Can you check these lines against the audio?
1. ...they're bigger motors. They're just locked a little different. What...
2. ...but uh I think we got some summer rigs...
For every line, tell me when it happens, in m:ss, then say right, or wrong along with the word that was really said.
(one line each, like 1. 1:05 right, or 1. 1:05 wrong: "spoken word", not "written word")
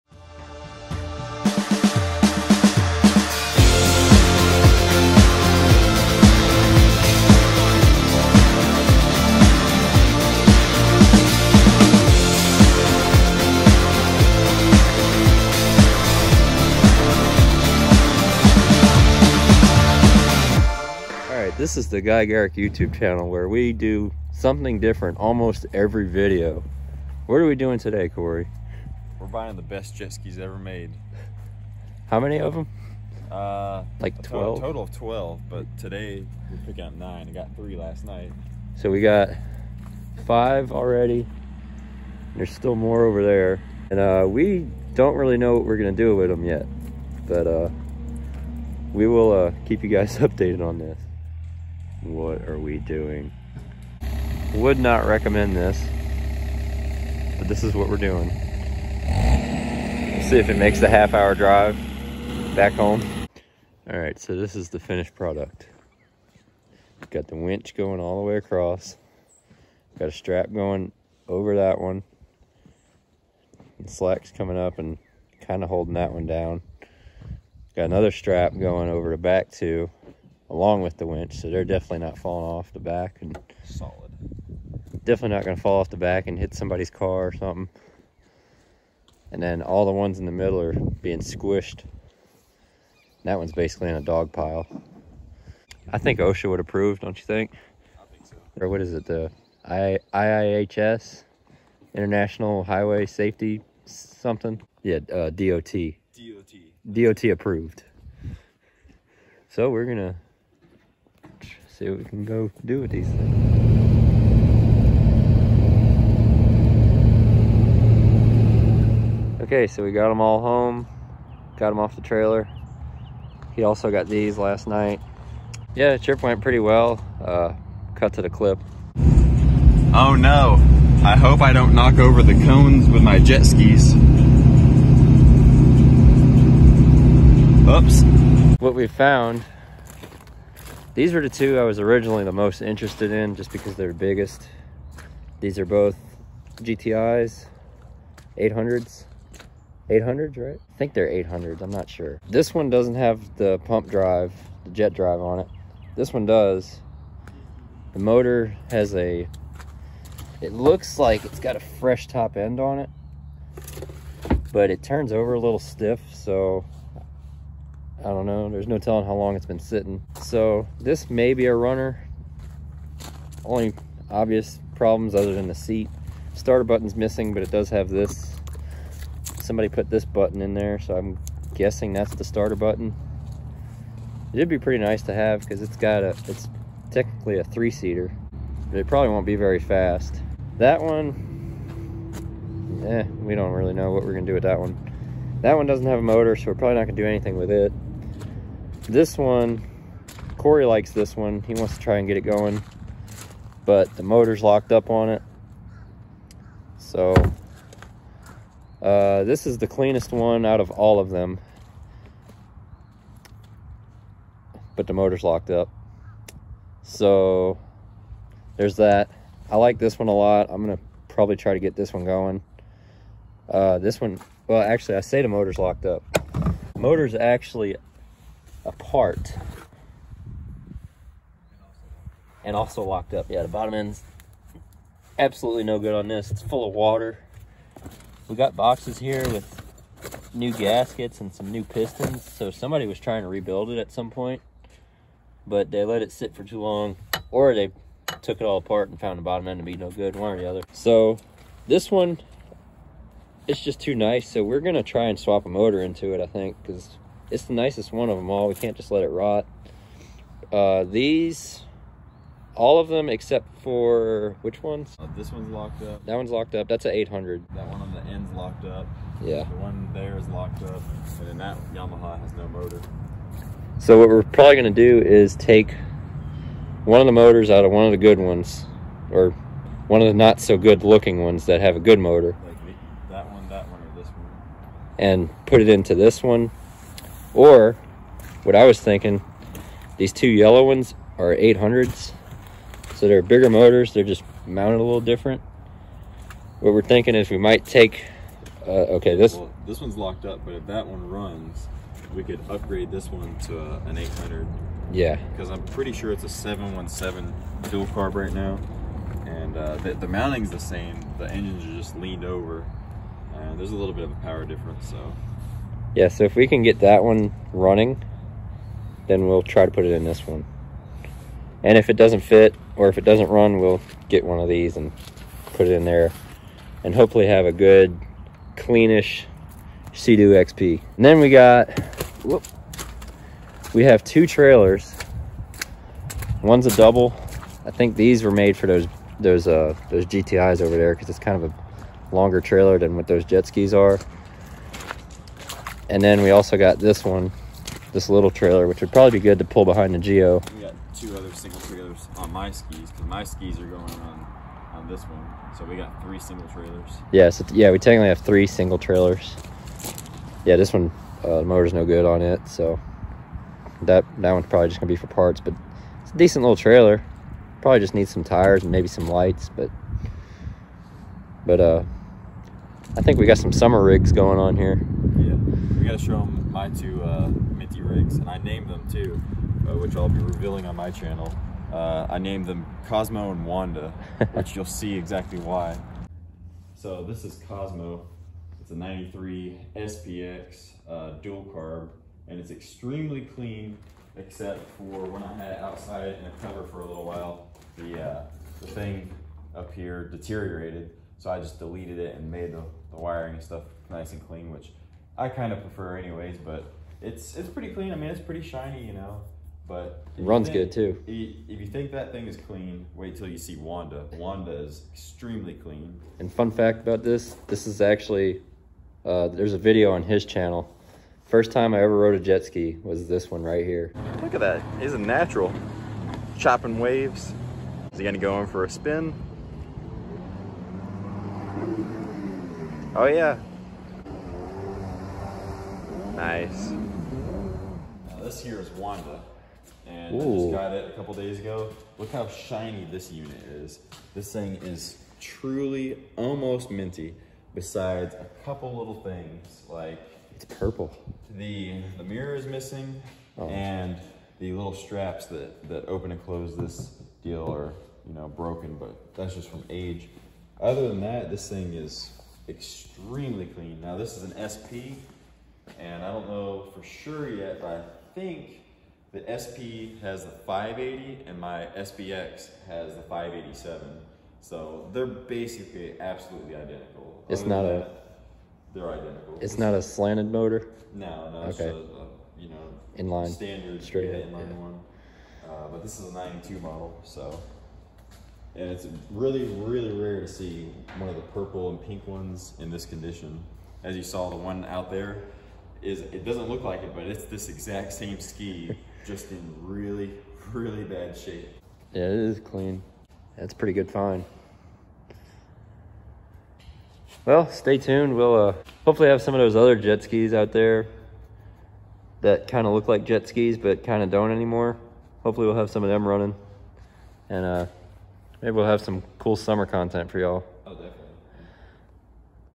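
1. 4:53 wrong: "mounted", not "locked"
2. 6:11 right.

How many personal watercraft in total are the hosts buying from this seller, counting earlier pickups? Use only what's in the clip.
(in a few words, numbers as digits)
12.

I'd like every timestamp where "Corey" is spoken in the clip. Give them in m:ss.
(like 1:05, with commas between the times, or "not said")
0:28, 3:20.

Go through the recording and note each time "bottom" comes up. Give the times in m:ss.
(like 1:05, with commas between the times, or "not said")
3:53, 4:09.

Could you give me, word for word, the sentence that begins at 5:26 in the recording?
And hopefully have a good, cleanish Sea-Doo XP.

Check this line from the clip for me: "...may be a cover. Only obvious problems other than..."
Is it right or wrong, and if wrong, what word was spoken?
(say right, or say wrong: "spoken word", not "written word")
wrong: "runner", not "cover".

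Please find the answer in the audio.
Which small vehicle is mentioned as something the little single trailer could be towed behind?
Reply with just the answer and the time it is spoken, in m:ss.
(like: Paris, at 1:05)
Geo, at 5:49.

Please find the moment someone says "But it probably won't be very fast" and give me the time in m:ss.
3:08.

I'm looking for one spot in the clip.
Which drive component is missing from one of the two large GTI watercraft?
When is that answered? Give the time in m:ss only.
2:34.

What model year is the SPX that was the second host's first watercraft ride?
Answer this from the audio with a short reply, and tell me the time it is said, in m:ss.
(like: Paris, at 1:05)
1993, at 6:28.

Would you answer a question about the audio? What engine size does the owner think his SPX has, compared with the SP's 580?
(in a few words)
587.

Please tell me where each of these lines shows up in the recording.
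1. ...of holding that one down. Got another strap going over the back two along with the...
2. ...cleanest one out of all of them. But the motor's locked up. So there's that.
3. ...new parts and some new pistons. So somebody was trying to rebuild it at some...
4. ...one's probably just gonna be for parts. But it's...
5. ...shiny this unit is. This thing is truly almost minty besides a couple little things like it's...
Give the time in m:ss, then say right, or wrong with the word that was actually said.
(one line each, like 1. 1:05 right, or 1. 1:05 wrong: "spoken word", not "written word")
1. 1:15 right
2. 3:29 right
3. 4:00 wrong: "gaskets", not "parts"
4. 6:04 right
5. 7:22 right.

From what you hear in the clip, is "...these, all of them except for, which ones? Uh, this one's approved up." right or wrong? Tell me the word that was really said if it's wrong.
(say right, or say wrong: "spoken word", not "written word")
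wrong: "locked", not "approved".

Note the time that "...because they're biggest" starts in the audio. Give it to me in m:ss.
2:23.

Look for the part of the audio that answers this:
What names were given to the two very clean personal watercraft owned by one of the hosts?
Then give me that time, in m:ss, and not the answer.
6:22.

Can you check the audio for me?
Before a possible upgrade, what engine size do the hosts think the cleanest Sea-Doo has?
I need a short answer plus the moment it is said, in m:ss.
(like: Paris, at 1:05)
717, at 5:06.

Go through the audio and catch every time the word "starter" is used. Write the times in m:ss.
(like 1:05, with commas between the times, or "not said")
2:56, 3:02.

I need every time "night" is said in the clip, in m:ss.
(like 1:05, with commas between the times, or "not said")
0:38, 2:04.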